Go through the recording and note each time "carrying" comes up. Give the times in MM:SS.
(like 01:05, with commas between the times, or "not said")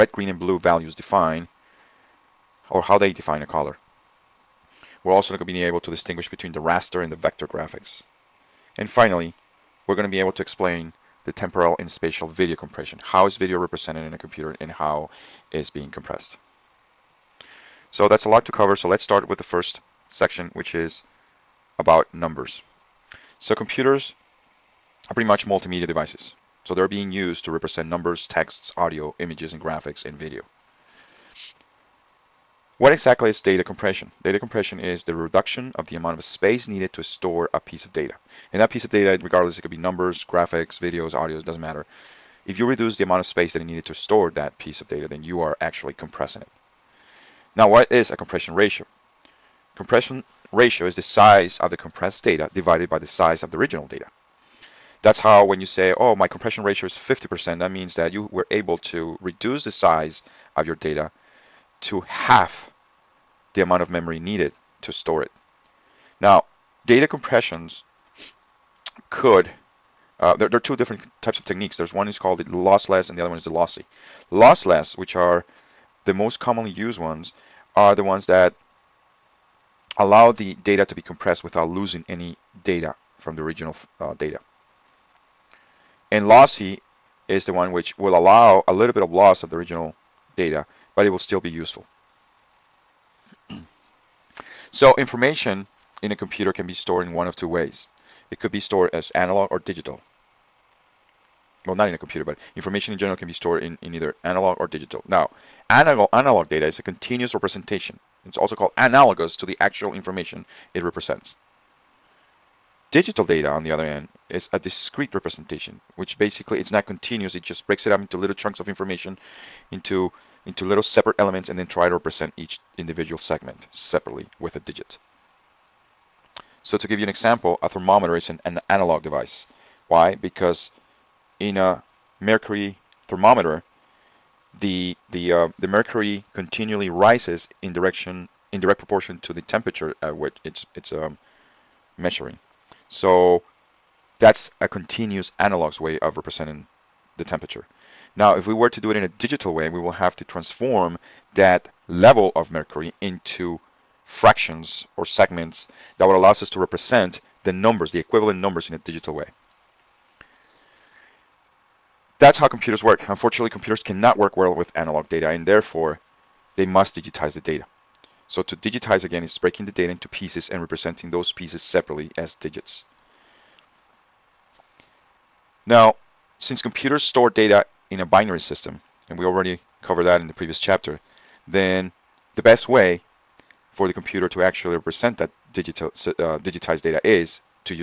not said.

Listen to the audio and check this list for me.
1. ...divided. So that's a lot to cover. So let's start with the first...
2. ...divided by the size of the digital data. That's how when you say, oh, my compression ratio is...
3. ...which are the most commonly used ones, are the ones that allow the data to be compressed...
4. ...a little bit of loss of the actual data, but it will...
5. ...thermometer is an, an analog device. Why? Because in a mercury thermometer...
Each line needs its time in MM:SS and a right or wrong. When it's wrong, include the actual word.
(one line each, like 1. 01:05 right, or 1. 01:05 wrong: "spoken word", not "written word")
1. 00:15 wrong: "compressed", not "divided"
2. 00:52 wrong: "original", not "digital"
3. 01:14 right
4. 01:28 wrong: "original", not "actual"
5. 02:07 right.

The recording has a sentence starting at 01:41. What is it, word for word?
Well, not in a computer, but information in general can be stored in, in either analog or digital.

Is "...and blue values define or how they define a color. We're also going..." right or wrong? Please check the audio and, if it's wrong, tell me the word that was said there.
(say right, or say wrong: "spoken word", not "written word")
right.